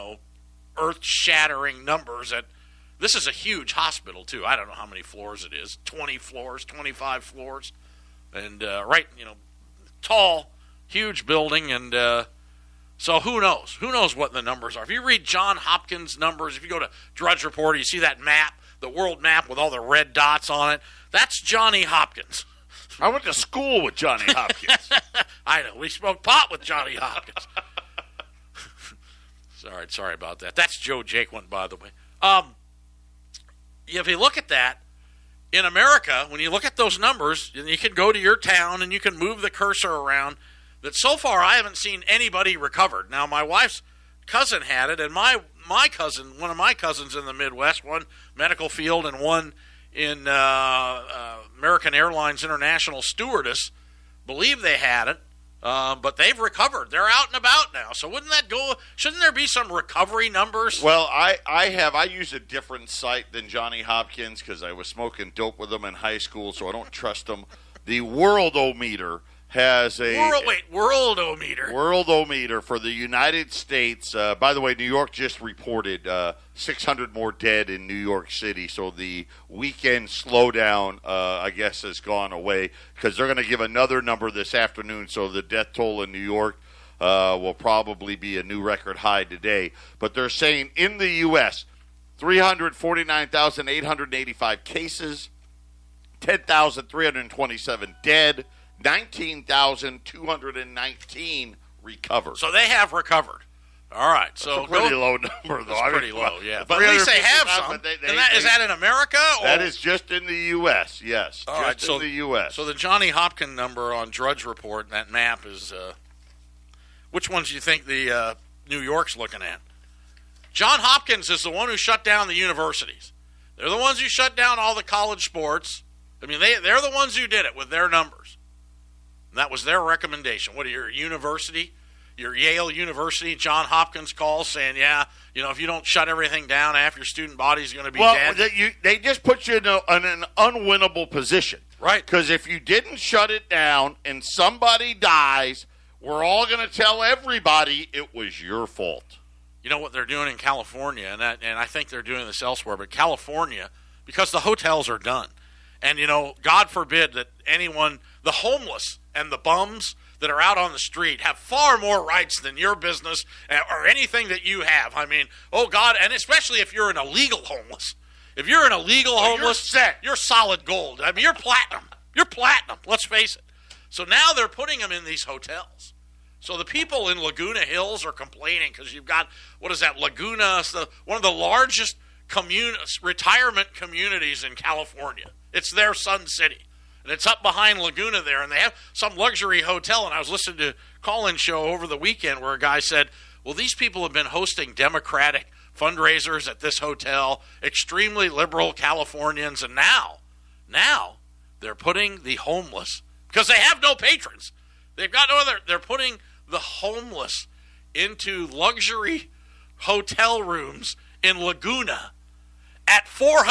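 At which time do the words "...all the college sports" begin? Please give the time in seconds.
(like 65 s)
124 s.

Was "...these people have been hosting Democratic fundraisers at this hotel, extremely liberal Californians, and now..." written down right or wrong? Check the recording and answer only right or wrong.
right.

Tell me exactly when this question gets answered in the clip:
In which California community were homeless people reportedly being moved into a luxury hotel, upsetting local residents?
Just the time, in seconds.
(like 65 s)
177 s.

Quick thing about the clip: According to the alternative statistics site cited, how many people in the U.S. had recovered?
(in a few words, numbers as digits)
19,219.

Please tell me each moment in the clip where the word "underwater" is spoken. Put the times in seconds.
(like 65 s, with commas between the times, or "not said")
not said.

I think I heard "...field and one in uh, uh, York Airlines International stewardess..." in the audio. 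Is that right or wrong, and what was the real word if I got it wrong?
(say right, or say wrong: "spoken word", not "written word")
wrong: "American", not "York".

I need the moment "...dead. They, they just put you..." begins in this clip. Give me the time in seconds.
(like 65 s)
138 s.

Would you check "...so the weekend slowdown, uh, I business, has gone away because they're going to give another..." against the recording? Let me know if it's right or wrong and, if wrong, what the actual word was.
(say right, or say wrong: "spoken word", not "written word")
wrong: "guess", not "business".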